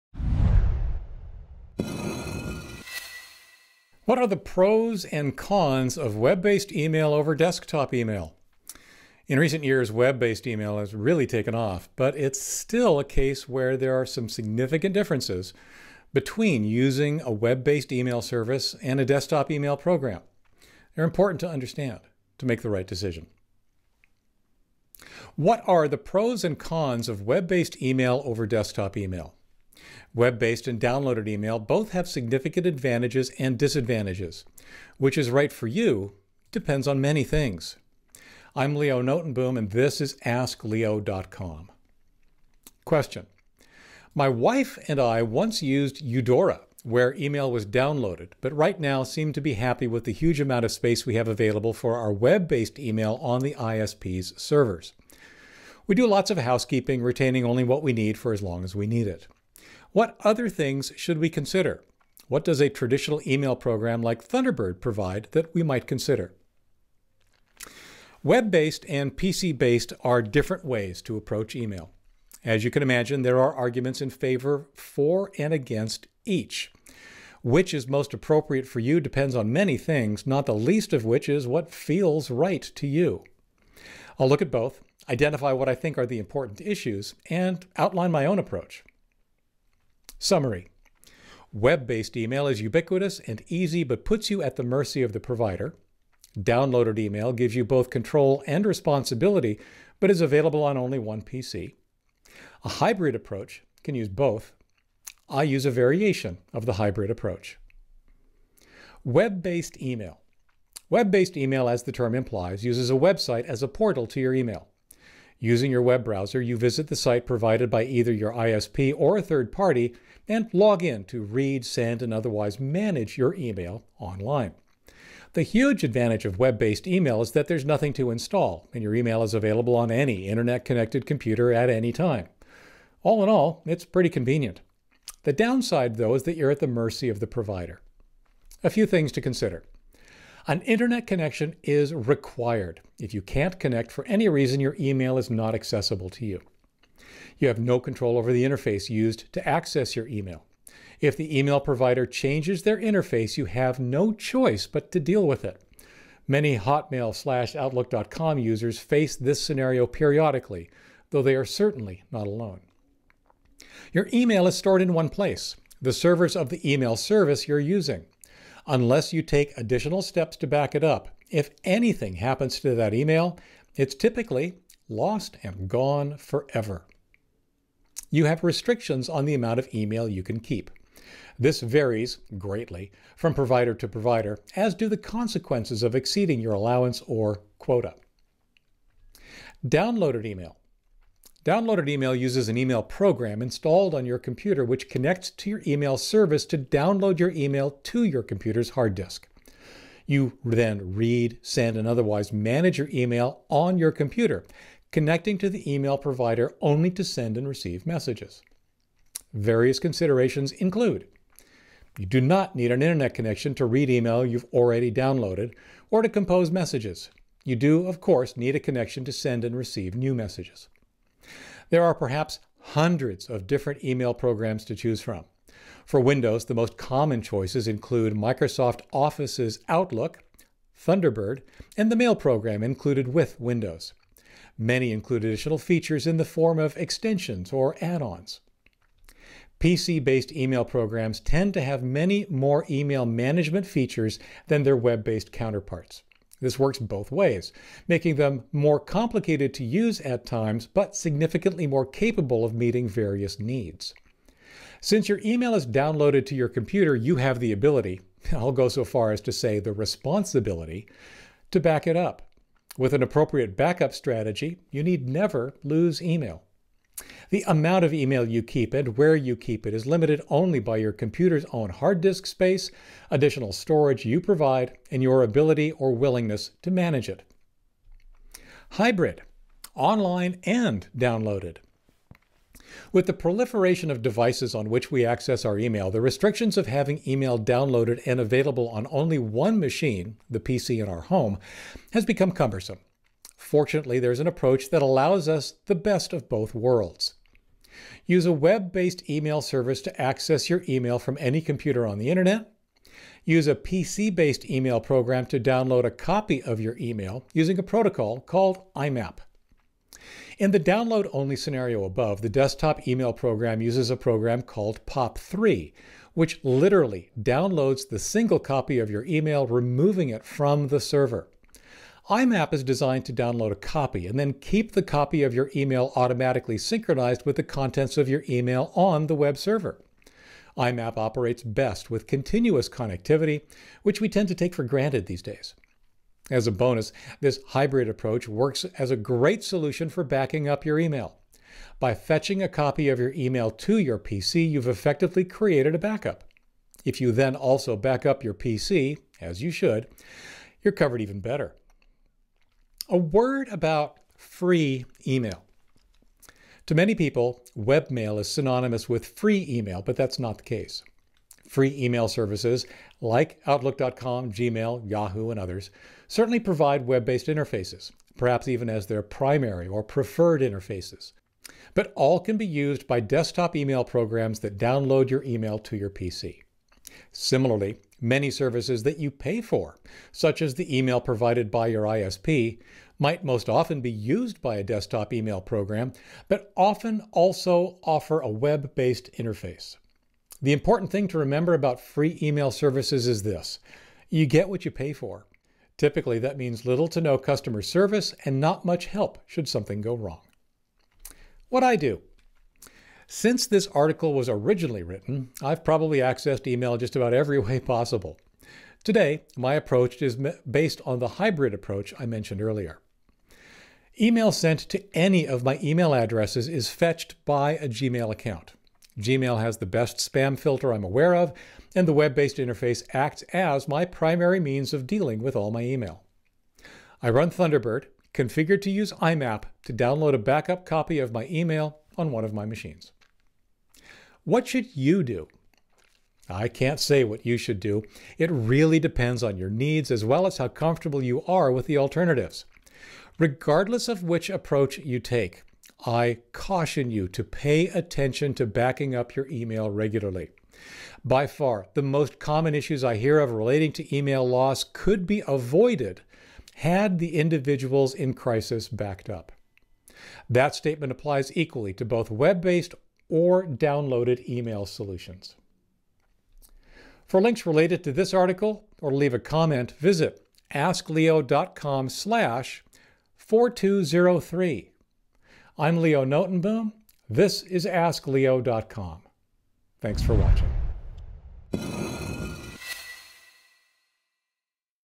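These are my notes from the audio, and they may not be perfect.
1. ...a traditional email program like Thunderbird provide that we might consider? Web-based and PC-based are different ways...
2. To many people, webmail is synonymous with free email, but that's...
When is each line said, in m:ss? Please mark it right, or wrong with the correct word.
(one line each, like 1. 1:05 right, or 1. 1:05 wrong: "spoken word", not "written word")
1. 1:02 right
2. 5:56 right.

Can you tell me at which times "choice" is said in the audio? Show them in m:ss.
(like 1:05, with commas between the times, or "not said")
2:34, 3:47.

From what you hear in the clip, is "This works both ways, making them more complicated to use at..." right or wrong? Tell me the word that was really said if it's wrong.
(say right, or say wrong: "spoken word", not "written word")
right.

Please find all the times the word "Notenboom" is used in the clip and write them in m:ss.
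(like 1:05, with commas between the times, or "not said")
0:39, 7:56.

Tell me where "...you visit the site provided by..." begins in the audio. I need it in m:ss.
1:56.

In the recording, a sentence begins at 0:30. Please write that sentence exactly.
Web based and downloaded email both have significant advantages and disadvantages.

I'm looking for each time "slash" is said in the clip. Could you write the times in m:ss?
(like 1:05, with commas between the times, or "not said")
2:37, 7:51.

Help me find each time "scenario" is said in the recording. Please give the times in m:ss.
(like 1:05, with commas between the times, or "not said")
2:39, 5:11.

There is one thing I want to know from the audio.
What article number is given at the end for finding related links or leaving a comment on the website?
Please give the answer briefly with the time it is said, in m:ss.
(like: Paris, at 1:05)
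4203, at 7:53.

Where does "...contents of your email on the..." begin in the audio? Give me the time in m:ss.
5:27.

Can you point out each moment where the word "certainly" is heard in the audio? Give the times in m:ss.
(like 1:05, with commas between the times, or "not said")
2:41, 6:06.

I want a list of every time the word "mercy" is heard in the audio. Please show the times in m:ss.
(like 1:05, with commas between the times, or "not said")
1:34, 2:16.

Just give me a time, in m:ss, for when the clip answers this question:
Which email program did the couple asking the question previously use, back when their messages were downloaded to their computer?
0:46.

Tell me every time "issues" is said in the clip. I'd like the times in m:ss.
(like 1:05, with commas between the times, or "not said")
1:26, 7:32.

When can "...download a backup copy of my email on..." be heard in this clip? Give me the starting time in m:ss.
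7:09.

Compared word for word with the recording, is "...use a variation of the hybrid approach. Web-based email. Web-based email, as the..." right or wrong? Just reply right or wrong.
right.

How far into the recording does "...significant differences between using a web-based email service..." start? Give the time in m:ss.
0:14.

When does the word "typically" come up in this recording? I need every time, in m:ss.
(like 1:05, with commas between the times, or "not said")
2:53, 6:35.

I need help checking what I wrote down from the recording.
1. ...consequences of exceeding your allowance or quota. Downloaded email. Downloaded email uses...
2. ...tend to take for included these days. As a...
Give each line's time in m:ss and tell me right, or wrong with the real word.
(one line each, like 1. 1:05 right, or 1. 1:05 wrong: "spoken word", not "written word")
1. 3:04 right
2. 5:34 wrong: "granted", not "included".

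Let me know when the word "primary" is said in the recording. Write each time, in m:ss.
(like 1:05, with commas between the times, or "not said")
6:09, 7:03.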